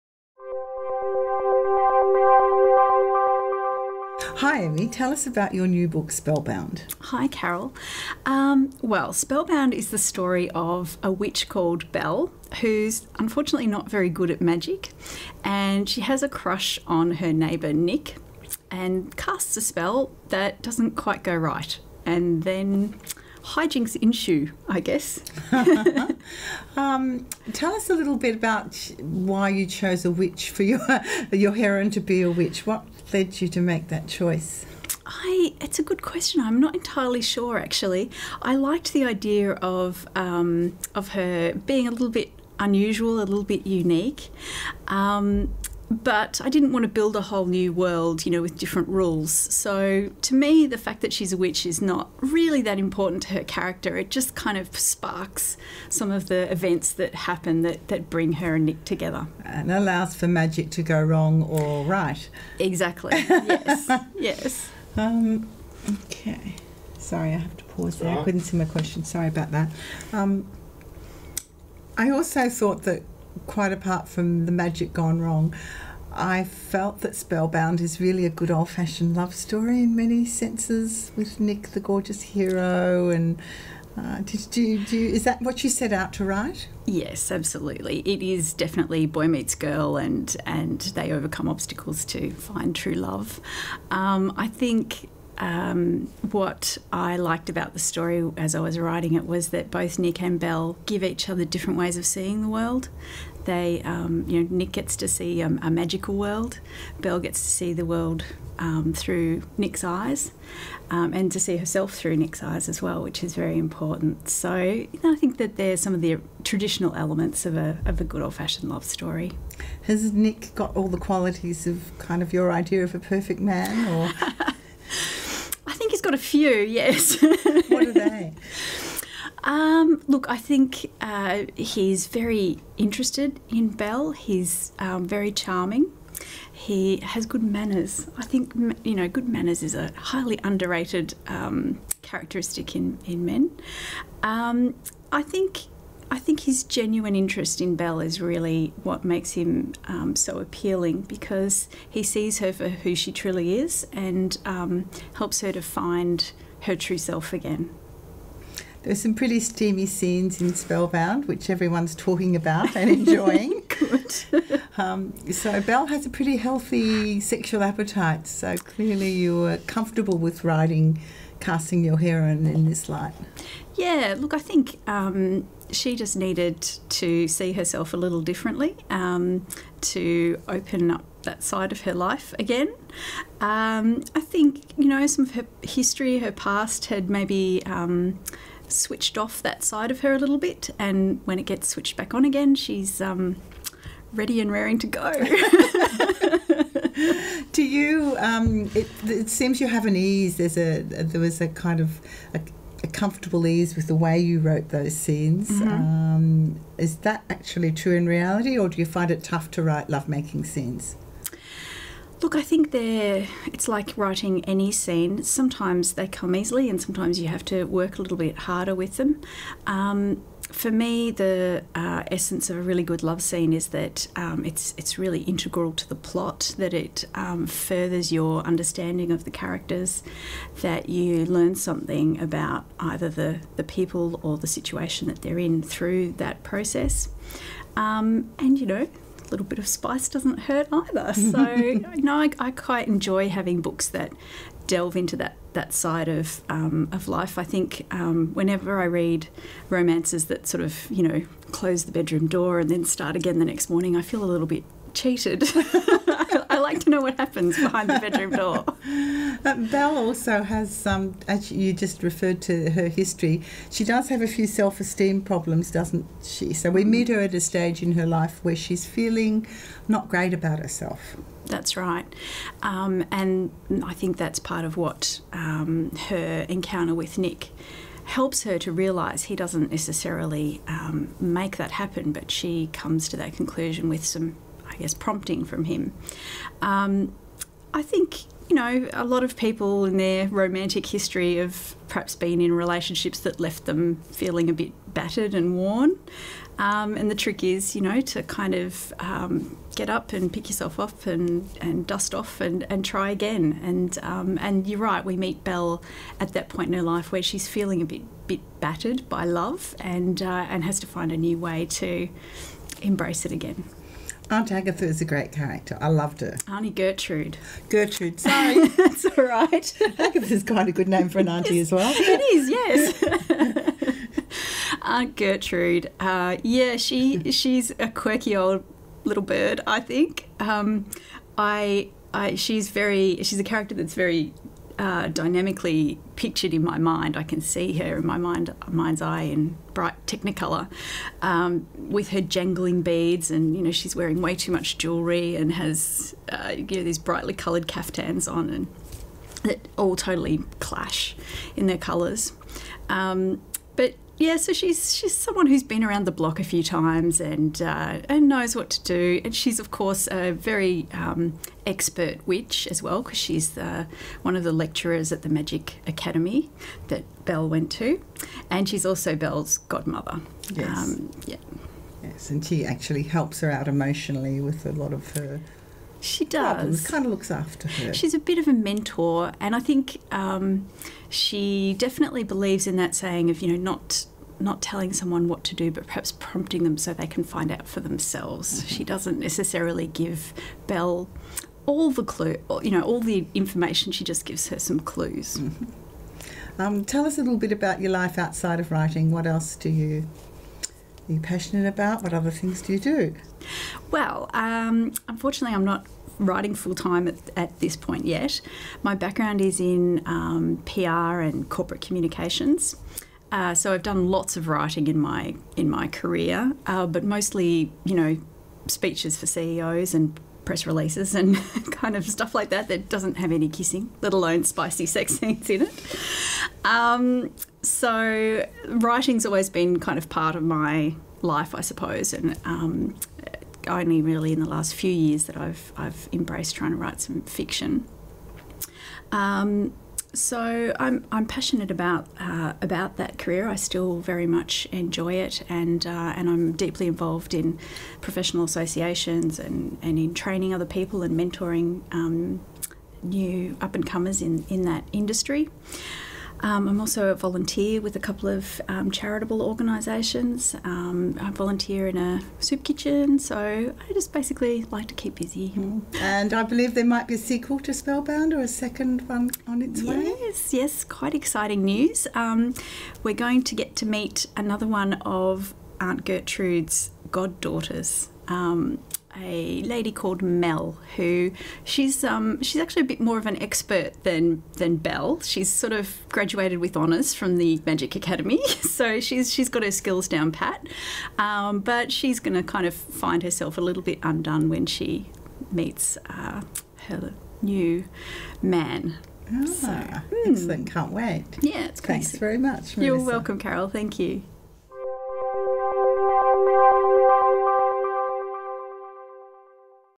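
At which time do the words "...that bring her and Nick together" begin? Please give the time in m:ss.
0:57.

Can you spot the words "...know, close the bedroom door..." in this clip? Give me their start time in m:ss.
4:11.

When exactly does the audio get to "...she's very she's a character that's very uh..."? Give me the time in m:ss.
5:32.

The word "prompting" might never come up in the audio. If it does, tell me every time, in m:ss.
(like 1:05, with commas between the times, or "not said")
4:44, 6:26.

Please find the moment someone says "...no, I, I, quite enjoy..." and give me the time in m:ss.
4:01.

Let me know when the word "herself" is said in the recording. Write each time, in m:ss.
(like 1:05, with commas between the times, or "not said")
1:51, 2:57, 4:30, 8:13.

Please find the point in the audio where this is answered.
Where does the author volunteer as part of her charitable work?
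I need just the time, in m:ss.
7:42.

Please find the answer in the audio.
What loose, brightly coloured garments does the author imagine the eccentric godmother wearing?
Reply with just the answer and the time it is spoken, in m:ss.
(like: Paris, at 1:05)
Caftans, at 5:47.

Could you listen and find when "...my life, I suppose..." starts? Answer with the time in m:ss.
7:10.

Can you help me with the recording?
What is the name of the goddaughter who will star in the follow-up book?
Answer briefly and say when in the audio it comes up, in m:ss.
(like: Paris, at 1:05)
Mel, at 8:00.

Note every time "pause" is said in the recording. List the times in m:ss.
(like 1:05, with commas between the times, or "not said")
1:07.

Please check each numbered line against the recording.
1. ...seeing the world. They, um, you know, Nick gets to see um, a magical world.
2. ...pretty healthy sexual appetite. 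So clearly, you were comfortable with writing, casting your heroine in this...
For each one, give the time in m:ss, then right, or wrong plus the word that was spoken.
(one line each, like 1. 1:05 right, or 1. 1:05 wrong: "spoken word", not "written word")
1. 1:42 right
2. 2:46 right.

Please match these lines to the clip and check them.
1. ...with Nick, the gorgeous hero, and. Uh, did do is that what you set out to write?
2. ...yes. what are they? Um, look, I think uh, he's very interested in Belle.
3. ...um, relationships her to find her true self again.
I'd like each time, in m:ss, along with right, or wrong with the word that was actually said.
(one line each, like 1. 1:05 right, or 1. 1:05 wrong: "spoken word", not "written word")
1. 1:21 right
2. 2:06 right
3. 2:34 wrong: "helps", not "relationships".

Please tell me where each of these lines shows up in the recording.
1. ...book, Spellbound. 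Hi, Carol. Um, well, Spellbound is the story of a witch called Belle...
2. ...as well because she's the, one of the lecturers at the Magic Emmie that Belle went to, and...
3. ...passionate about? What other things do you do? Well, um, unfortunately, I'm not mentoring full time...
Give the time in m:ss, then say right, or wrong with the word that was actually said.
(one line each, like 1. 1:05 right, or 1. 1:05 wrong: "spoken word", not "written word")
1. 0:05 right
2. 6:02 wrong: "Academy", not "Emmie"
3. 6:41 wrong: "writing", not "mentoring".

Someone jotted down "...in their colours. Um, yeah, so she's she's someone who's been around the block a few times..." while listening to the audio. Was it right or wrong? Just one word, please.
right.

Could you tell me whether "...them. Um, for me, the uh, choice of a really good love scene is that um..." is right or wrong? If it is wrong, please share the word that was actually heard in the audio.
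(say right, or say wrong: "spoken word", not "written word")
wrong: "essence", not "choice".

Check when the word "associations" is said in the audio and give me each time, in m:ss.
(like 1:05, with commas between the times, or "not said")
7:28.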